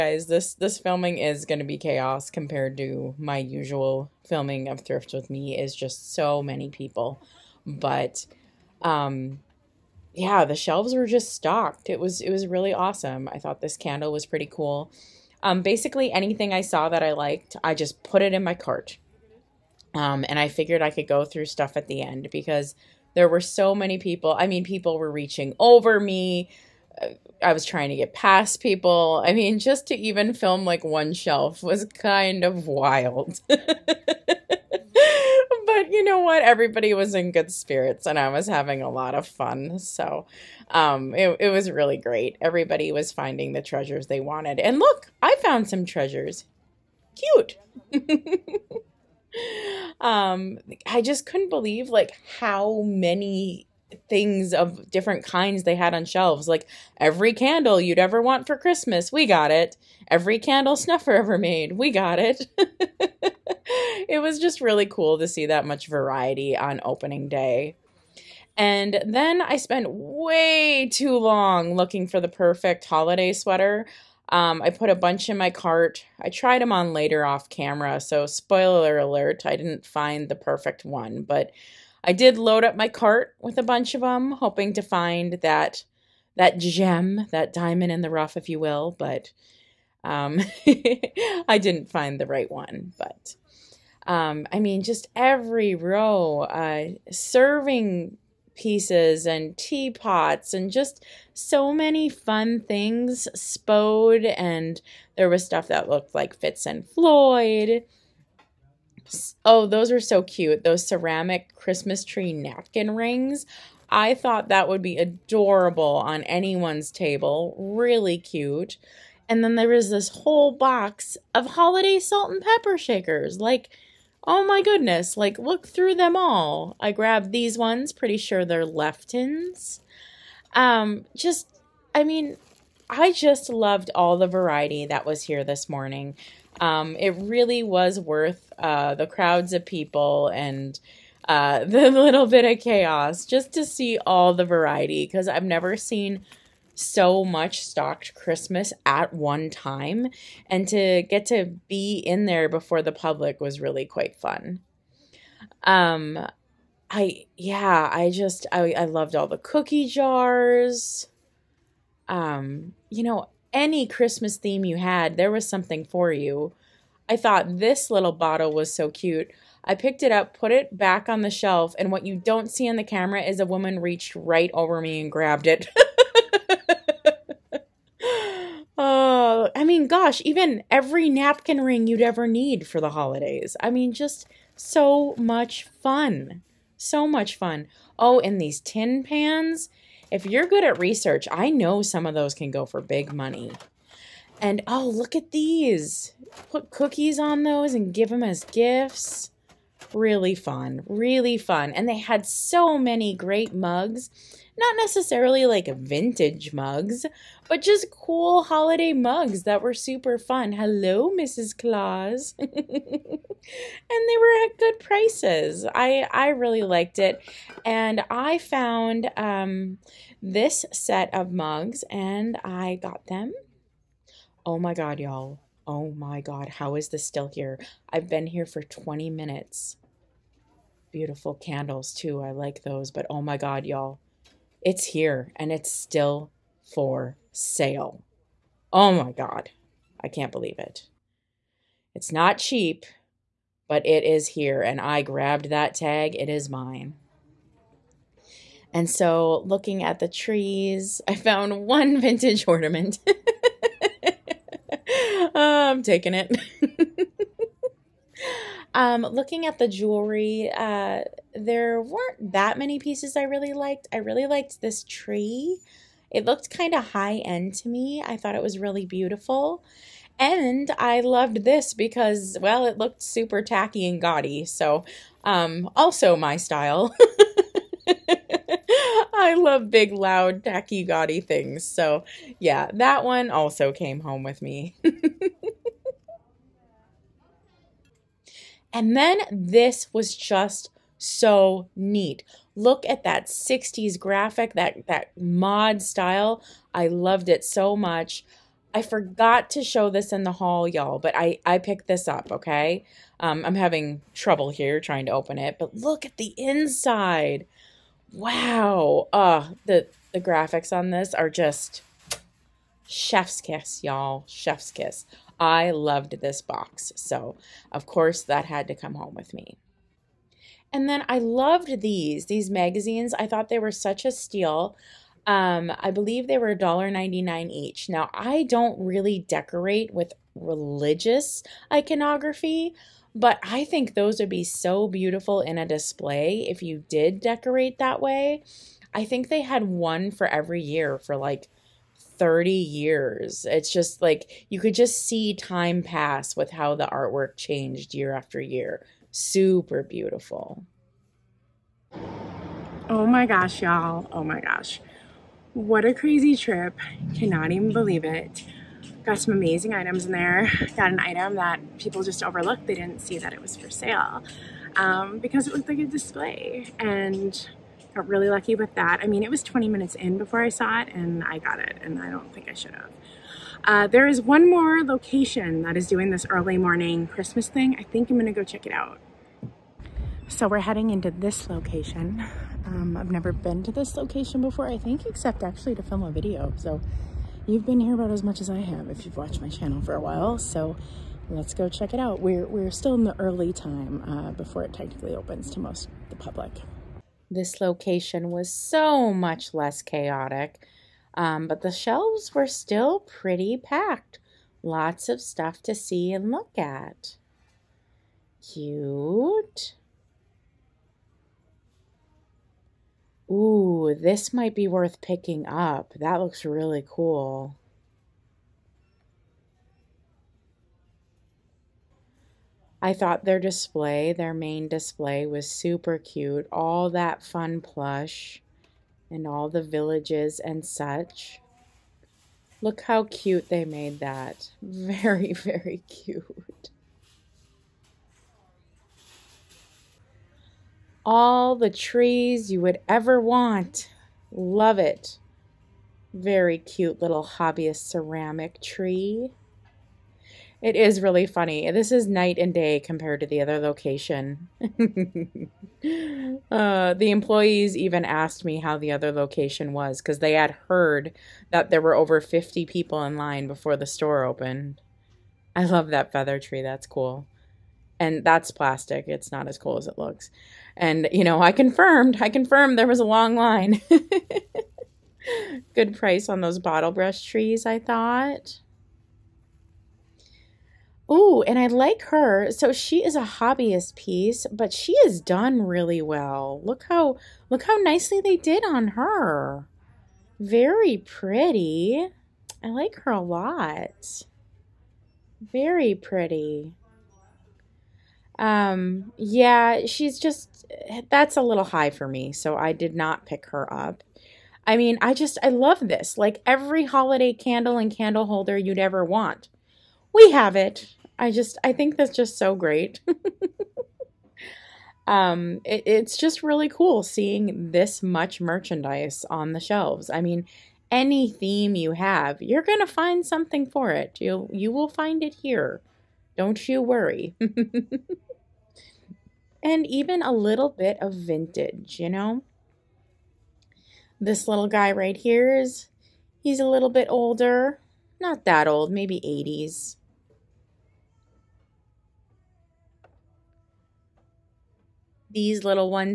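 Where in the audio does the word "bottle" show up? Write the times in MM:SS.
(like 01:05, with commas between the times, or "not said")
02:48, 07:56.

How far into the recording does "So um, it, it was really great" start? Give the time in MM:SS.
00:39.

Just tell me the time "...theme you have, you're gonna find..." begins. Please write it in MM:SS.
08:41.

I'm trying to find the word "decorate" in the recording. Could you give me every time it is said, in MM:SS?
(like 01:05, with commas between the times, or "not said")
05:29, 05:37.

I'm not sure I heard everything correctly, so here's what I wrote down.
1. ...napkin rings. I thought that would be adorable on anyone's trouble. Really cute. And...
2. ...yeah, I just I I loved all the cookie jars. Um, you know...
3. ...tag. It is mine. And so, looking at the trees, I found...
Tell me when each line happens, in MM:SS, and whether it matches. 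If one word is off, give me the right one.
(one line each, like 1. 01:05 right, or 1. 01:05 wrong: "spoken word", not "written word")
1. 01:52 wrong: "table", not "trouble"
2. 02:37 right
3. 04:05 right.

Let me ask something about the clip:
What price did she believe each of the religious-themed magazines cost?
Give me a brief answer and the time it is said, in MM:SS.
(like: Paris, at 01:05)
$1.99, at 05:26.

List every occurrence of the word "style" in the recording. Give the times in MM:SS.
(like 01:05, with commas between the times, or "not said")
04:36, 04:55.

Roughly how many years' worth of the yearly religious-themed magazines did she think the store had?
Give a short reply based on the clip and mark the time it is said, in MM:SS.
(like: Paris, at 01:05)
30, at 05:42.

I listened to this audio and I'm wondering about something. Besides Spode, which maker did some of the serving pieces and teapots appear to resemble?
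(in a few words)
Fitz and Floyd.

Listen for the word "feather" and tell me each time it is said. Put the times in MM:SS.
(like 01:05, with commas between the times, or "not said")
07:46.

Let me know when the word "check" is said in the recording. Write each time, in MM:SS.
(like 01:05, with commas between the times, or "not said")
06:18, 06:31.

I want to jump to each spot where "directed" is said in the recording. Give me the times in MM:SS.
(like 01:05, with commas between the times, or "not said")
not said.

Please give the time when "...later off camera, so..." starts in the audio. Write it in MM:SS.
01:16.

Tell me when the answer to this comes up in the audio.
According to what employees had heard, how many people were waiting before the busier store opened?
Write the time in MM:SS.
07:41.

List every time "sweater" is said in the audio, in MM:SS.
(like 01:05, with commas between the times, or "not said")
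01:13.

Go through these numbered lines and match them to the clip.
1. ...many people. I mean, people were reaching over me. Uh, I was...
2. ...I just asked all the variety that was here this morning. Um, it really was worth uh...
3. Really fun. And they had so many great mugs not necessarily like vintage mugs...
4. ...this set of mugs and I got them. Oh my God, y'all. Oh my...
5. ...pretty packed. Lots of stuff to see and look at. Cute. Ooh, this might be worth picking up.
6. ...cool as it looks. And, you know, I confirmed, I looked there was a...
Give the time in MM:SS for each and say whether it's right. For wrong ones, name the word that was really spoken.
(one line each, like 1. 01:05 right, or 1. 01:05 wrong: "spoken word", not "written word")
1. 00:23 right
2. 02:12 wrong: "loved", not "asked"
3. 03:20 right
4. 03:40 right
5. 06:43 right
6. 07:49 wrong: "confirmed", not "looked".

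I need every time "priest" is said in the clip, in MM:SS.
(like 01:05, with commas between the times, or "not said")
not said.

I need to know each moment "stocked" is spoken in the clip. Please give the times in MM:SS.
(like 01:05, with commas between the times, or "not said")
00:11, 02:27.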